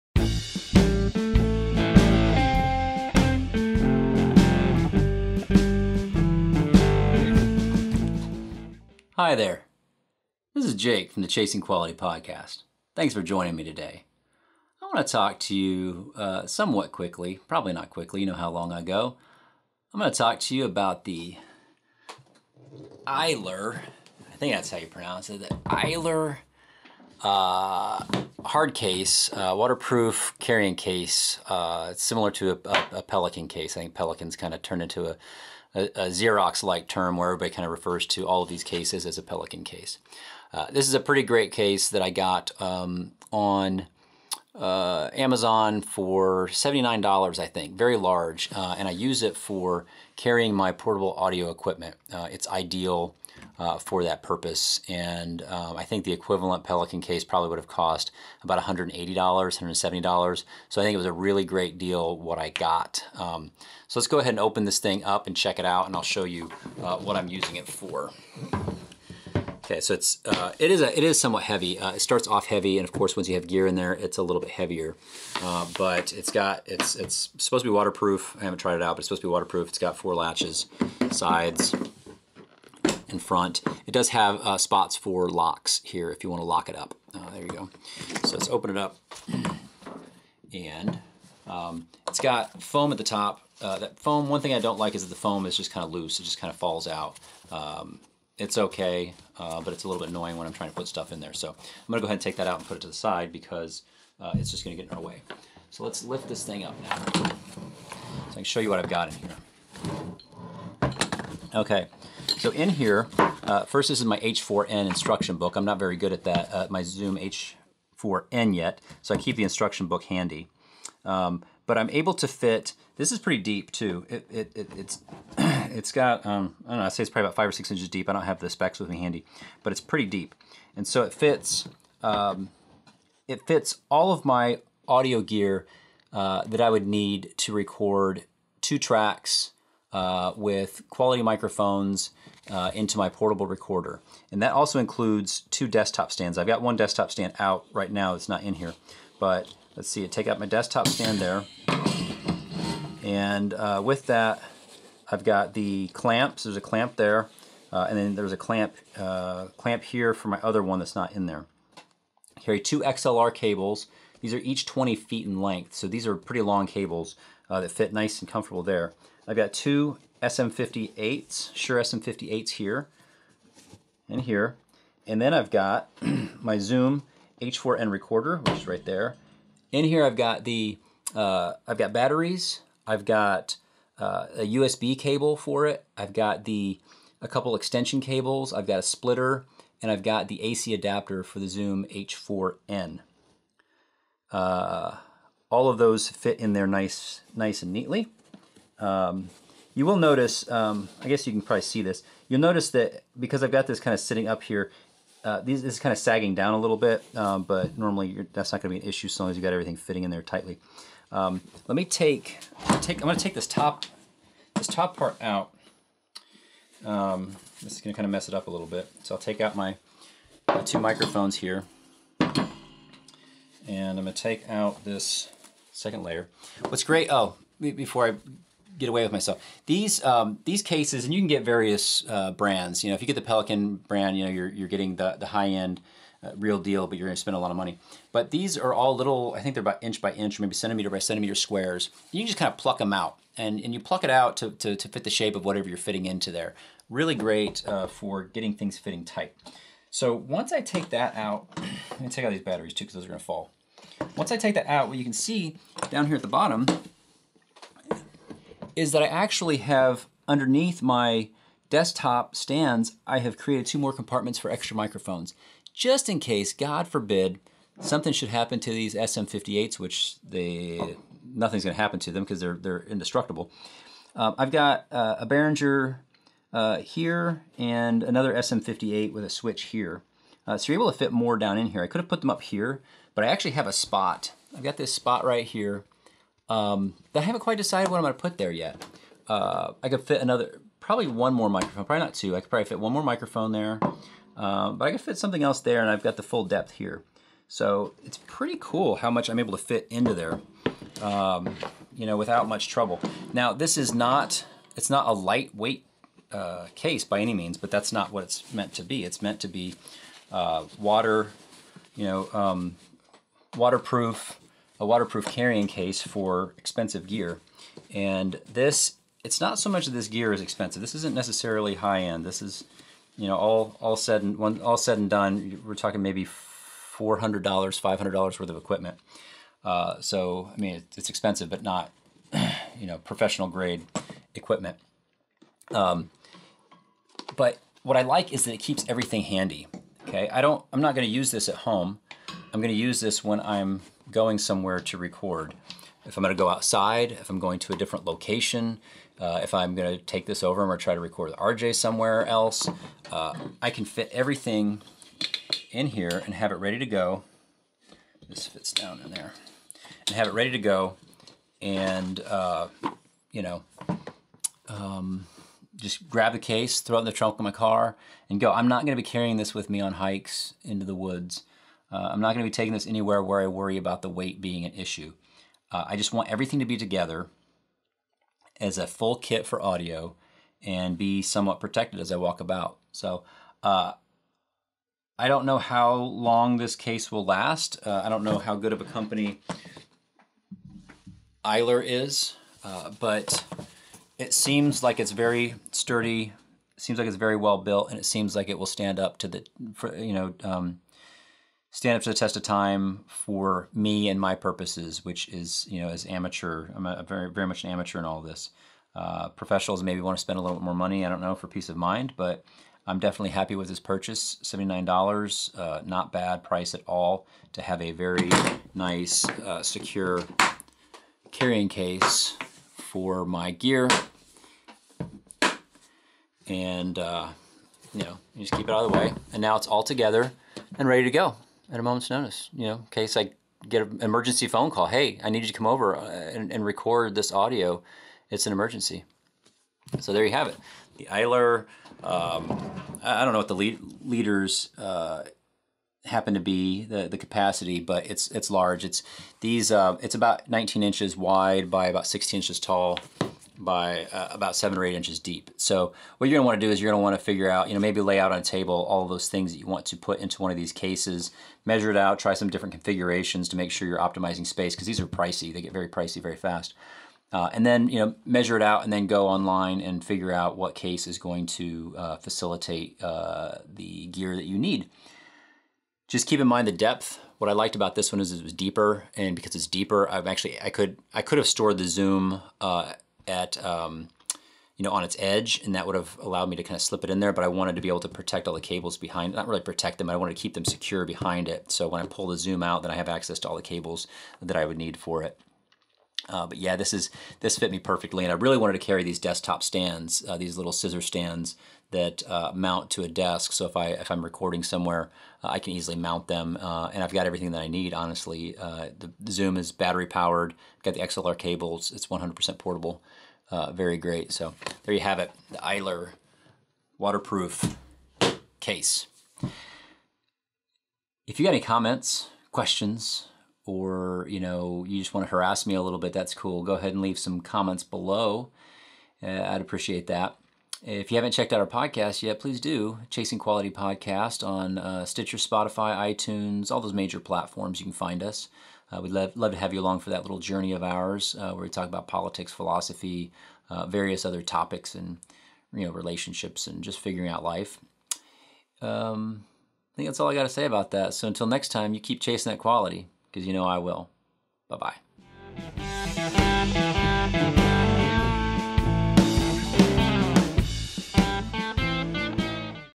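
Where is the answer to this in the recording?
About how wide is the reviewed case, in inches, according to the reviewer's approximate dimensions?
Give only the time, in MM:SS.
07:30.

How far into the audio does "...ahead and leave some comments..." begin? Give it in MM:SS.
08:46.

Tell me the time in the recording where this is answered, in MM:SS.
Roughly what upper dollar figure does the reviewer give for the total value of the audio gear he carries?
05:27.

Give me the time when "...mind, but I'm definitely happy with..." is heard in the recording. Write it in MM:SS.
06:51.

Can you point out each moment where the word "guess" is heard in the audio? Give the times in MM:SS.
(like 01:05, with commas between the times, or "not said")
03:21.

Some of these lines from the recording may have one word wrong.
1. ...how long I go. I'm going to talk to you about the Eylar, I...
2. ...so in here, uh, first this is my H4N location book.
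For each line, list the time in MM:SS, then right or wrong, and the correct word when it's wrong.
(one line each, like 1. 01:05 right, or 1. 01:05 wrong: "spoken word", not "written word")
1. 00:18 right
2. 01:52 wrong: "instruction", not "location".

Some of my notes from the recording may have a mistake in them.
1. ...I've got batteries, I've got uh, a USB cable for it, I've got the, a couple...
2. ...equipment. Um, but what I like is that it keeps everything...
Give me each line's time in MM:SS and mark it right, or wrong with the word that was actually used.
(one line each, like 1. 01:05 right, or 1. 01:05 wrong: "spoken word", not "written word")
1. 03:01 right
2. 05:34 right.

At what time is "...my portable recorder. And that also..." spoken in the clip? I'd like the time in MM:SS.
02:22.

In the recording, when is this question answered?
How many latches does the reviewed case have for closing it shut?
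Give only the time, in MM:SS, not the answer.
01:19.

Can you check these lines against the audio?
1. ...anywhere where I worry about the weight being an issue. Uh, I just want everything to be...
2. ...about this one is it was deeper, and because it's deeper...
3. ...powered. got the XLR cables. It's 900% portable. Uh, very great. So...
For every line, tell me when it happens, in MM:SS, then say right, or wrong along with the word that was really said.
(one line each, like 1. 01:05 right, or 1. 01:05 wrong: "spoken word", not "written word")
1. 06:12 right
2. 07:57 right
3. 08:30 wrong: "100", not "900".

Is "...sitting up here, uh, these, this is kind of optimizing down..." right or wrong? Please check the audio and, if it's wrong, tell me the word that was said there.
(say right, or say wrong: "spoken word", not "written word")
wrong: "sagging", not "optimizing".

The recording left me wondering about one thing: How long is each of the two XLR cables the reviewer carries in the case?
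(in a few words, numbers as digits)
20 feet.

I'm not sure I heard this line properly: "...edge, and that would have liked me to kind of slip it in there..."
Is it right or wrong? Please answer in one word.
wrong.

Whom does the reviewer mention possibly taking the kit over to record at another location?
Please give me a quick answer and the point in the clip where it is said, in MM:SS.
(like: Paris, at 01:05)
RJ, at 05:51.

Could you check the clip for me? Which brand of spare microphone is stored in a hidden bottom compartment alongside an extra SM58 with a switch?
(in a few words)
Behringer.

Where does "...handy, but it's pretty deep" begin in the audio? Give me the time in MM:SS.
02:08.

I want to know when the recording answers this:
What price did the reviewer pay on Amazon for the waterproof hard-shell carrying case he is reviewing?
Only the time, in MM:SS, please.
00:46.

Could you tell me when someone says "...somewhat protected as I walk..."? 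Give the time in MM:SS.
06:21.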